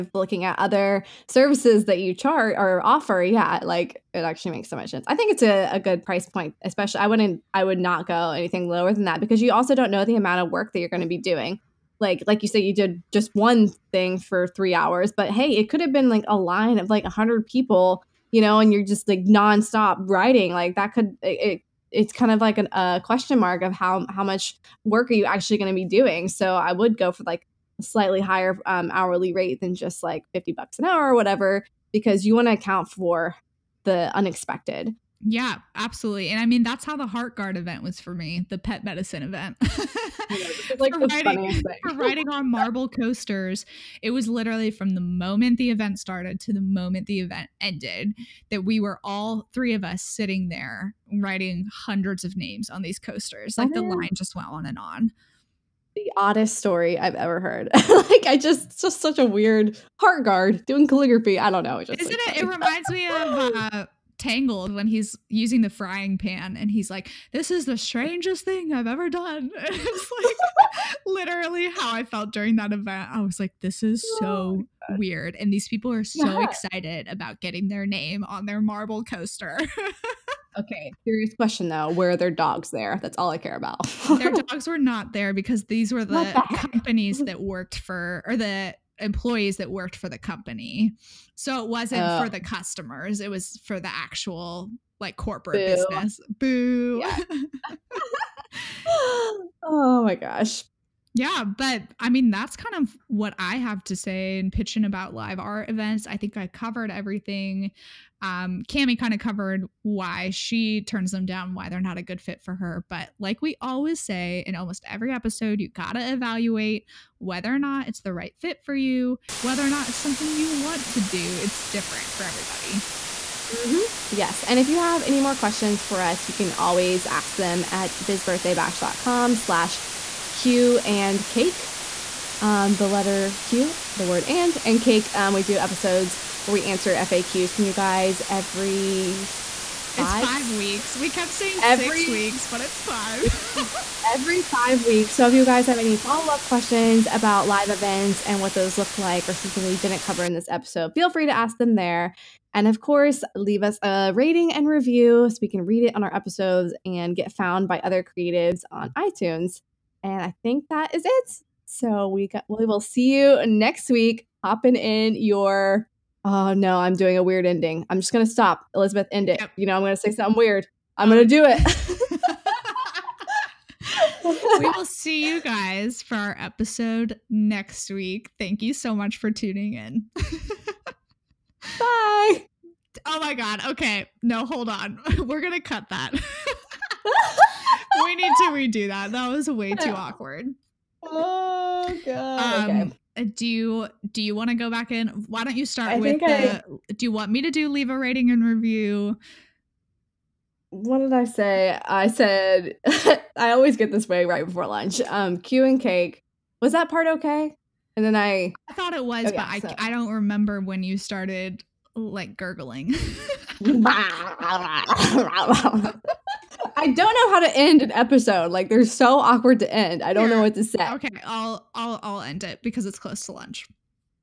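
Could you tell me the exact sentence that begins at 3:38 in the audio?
Like they're so awkward to end.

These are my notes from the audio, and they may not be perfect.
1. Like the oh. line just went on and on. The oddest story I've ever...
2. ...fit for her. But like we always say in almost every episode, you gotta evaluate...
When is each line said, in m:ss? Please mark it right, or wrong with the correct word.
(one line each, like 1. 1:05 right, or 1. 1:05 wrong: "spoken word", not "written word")
1. 0:53 right
2. 1:52 right.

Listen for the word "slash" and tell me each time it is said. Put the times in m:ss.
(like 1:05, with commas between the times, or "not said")
2:09.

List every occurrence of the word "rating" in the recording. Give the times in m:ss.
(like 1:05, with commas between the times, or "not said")
2:34, 3:17.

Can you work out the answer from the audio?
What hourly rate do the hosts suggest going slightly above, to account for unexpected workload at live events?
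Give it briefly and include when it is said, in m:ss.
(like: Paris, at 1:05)
$50 an hour, at 0:30.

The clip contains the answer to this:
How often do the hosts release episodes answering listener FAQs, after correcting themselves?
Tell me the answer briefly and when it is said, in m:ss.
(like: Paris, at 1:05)
Every 5 weeks, at 2:24.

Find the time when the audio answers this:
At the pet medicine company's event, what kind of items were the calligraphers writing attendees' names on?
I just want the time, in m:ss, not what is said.
0:42.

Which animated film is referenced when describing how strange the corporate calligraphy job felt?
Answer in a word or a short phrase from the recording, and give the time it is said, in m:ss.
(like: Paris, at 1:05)
Tangled, at 1:04.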